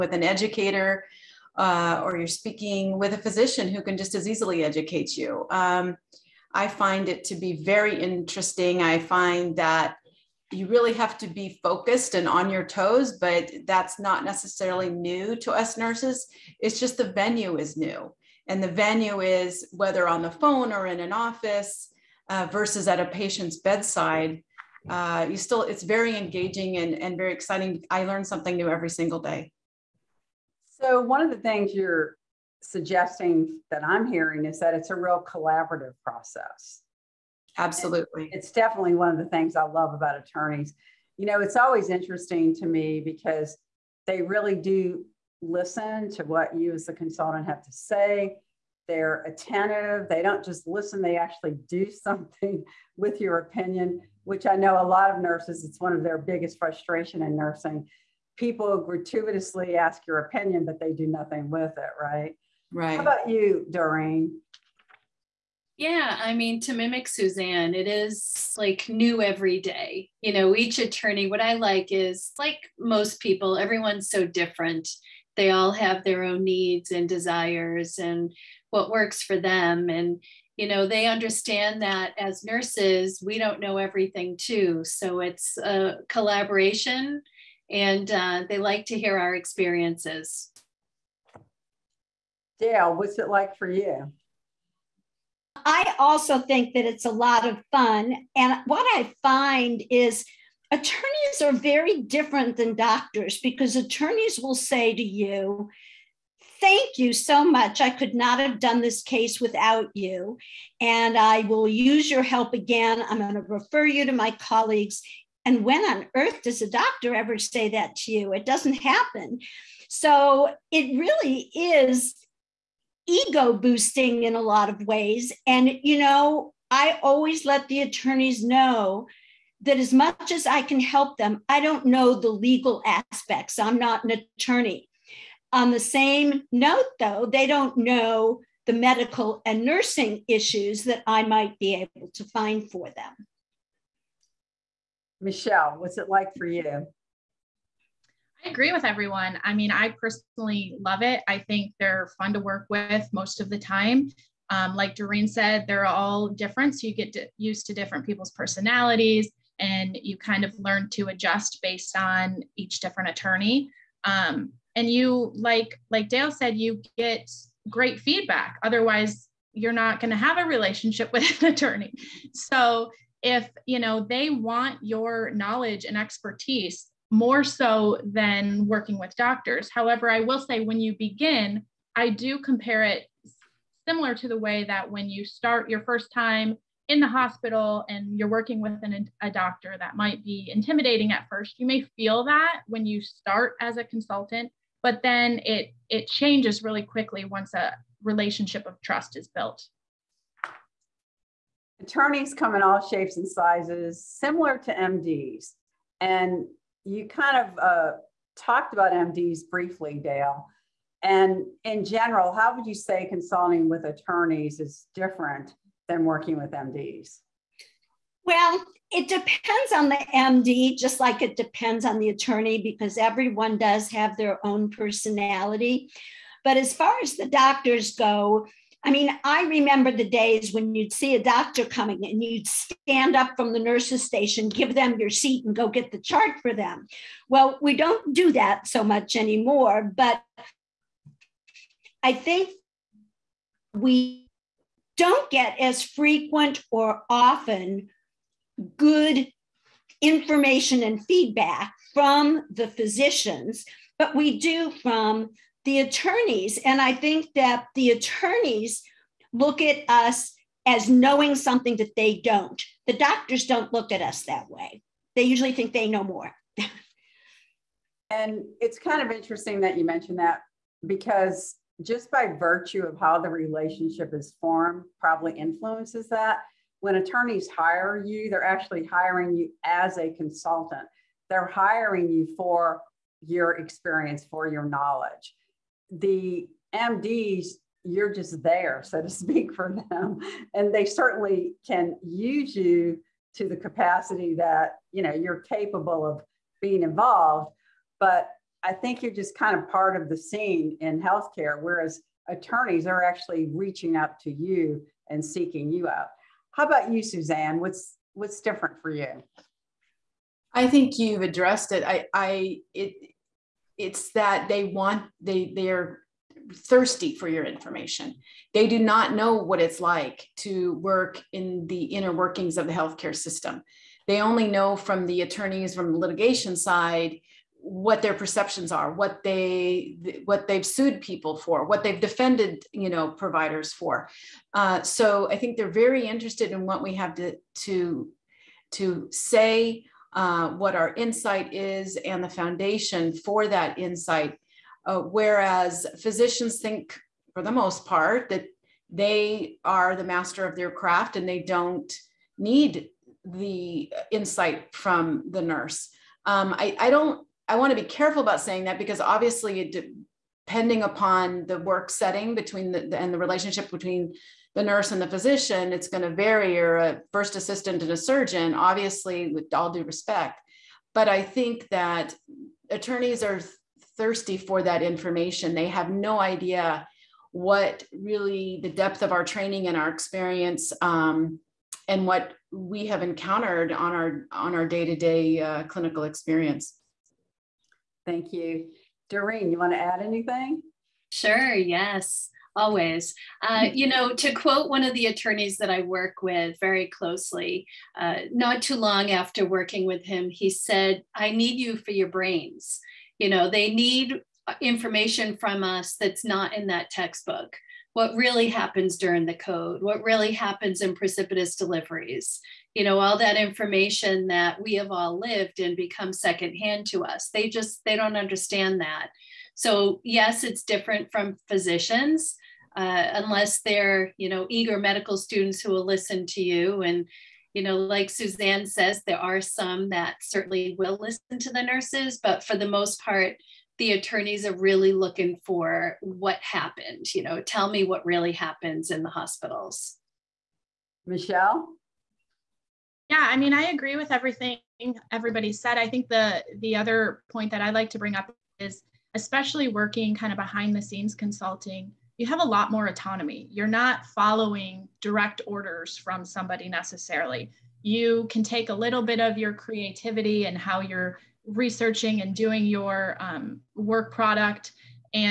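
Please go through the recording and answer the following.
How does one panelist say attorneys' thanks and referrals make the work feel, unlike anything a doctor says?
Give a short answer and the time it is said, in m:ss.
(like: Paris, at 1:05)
ego boosting, at 2:03.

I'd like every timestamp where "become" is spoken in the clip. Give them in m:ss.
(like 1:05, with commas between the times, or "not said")
6:55.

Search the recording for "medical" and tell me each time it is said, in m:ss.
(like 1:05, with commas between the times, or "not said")
2:18, 7:04.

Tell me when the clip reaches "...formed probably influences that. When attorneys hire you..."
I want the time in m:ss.
4:34.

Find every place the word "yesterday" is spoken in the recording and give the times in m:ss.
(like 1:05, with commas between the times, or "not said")
not said.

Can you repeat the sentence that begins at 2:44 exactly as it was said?
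Um, and you like like Dale said, you get great feedback.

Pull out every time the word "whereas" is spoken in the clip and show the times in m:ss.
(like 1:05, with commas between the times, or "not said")
5:01, 5:44.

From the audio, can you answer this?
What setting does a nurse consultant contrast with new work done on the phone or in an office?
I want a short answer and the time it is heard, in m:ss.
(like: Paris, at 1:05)
a patient's bedside, at 0:22.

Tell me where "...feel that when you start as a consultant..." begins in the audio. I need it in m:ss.
3:11.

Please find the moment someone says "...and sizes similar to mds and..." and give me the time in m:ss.
3:23.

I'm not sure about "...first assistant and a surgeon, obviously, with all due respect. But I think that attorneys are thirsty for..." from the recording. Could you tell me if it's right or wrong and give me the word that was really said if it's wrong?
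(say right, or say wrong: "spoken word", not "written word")
right.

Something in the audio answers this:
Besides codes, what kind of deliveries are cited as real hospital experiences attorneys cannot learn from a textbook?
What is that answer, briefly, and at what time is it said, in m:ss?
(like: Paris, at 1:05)
precipitous deliveries, at 6:50.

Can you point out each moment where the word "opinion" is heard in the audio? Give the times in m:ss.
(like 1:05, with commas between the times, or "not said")
0:53, 1:00.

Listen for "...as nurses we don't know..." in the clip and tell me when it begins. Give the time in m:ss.
1:22.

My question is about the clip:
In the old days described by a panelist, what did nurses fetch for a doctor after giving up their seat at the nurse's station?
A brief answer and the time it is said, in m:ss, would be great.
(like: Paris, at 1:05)
the chart, at 3:55.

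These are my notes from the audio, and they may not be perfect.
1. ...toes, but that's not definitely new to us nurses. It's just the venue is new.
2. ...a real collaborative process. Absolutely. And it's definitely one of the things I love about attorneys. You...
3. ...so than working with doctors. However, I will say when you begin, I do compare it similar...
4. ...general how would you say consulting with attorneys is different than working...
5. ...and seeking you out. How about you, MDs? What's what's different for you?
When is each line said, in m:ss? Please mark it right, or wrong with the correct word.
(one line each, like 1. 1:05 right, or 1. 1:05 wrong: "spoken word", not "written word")
1. 0:12 wrong: "necessarily", not "definitely"
2. 0:34 right
3. 2:57 right
4. 3:31 right
5. 5:05 wrong: "Suzanne", not "MDs".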